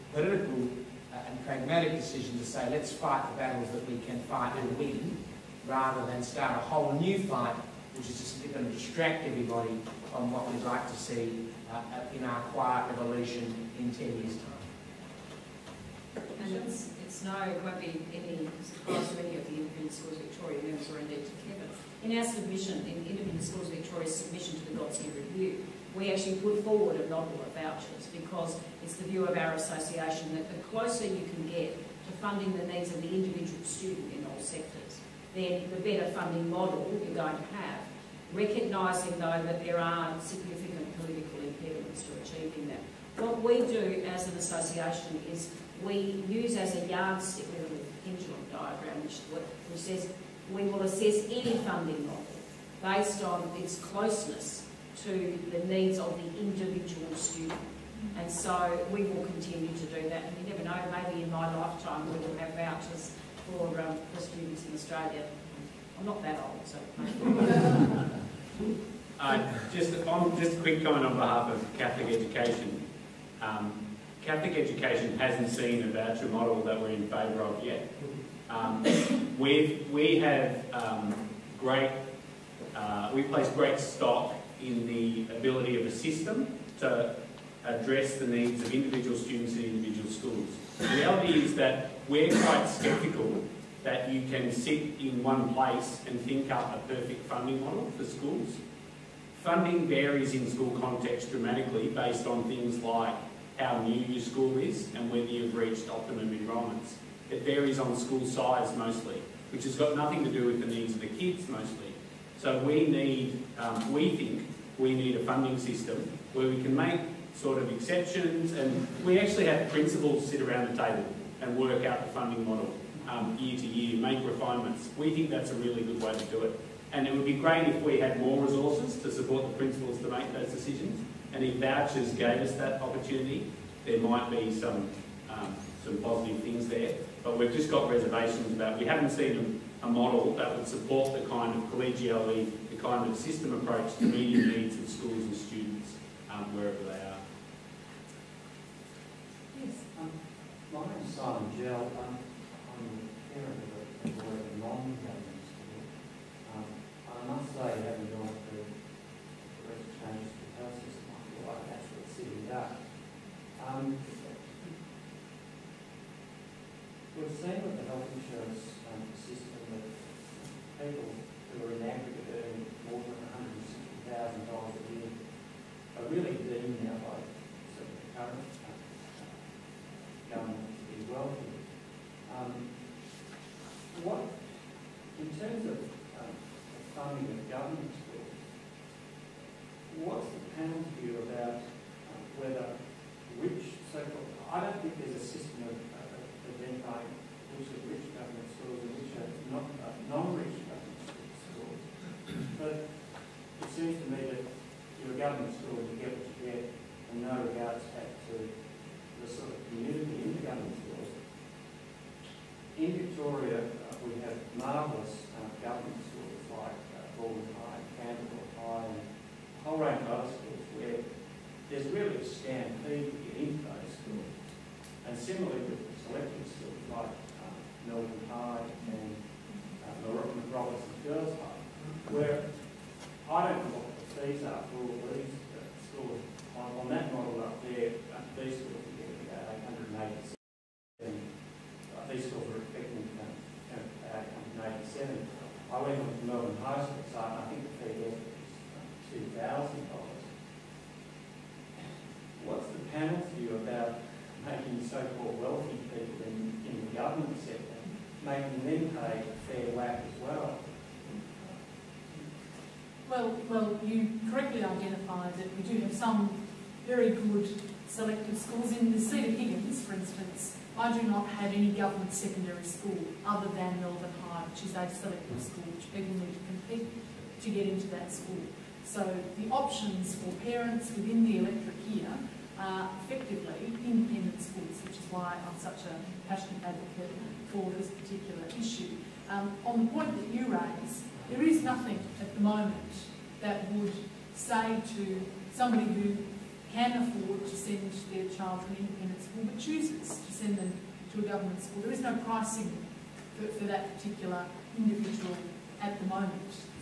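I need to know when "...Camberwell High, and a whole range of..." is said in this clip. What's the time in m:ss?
3:37.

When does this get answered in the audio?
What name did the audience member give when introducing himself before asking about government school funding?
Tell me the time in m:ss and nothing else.
2:31.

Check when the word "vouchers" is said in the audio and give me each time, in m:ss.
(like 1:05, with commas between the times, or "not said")
0:27, 1:02, 1:15, 2:11.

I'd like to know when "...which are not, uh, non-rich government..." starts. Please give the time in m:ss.
3:18.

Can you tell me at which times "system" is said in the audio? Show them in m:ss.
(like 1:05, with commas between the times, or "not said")
1:25, 1:55, 2:23, 3:15.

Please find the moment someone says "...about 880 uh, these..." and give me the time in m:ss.
3:59.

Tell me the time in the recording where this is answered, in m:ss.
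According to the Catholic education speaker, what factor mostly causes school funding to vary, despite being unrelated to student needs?
1:47.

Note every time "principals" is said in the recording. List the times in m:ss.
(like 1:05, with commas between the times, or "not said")
1:59, 2:09.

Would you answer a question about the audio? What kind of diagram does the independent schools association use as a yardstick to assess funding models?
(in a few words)
pendulum diagram.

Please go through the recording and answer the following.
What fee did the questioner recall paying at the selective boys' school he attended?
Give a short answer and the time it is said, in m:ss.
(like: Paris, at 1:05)
$2,000, at 4:09.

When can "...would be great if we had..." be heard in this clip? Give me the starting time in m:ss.
2:07.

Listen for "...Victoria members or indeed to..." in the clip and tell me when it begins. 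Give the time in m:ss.
0:20.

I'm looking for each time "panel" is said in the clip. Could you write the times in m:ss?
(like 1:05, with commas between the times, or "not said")
3:10, 4:12.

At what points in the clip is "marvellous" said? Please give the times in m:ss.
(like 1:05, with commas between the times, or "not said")
3:34.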